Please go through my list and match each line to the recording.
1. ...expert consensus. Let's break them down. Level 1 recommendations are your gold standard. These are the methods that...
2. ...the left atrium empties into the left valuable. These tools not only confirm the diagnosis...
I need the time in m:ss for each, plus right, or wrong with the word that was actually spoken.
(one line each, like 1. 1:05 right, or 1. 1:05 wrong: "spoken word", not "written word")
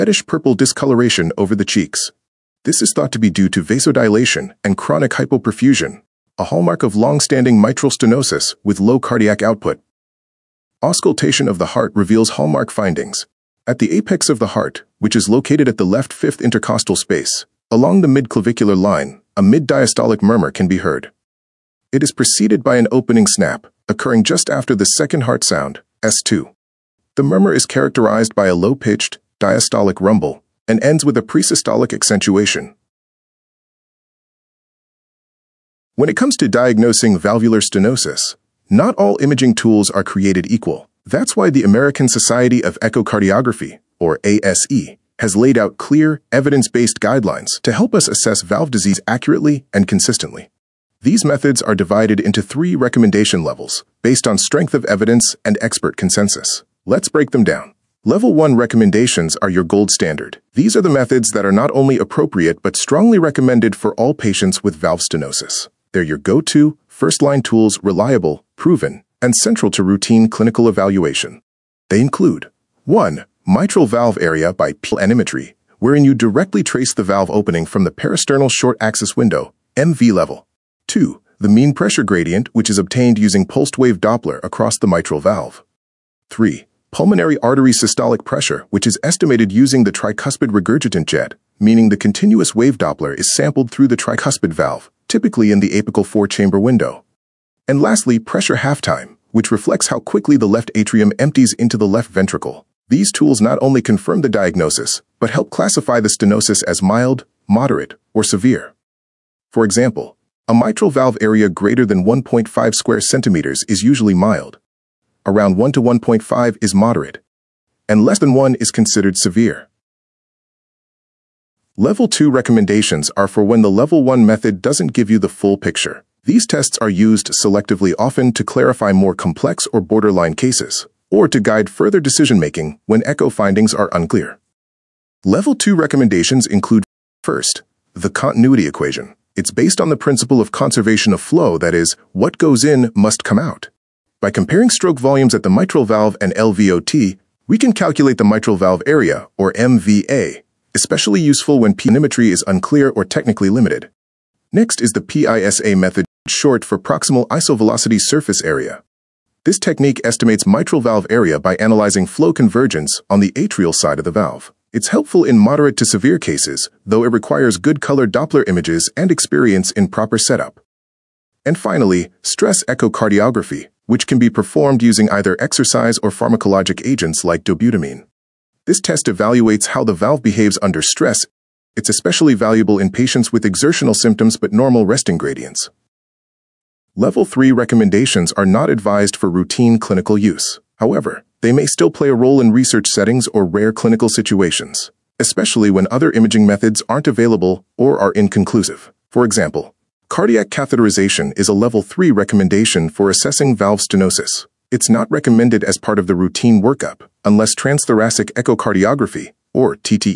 1. 0:55 right
2. 1:40 wrong: "ventricle", not "valuable".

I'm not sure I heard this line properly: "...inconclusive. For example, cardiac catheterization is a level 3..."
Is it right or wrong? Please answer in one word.
right.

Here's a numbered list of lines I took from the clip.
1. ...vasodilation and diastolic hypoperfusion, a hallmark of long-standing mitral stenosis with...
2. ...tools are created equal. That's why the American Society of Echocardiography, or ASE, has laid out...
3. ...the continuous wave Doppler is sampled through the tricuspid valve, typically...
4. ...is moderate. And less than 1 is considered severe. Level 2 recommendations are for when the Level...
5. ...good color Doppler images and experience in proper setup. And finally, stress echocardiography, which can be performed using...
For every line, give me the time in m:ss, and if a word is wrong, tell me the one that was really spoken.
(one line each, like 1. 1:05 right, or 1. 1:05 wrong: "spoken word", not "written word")
1. 0:03 wrong: "chronic", not "diastolic"
2. 0:39 right
3. 1:31 right
4. 1:56 right
5. 2:47 right.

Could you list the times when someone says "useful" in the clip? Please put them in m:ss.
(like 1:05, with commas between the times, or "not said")
2:31.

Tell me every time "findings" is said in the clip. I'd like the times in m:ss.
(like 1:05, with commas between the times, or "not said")
0:12, 2:13.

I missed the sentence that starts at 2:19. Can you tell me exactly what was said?
It's based on the principle of conservation of flow, that is, what goes in must come out.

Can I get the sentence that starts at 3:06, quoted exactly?
Level 3 recommendations are not advised for routine clinical use.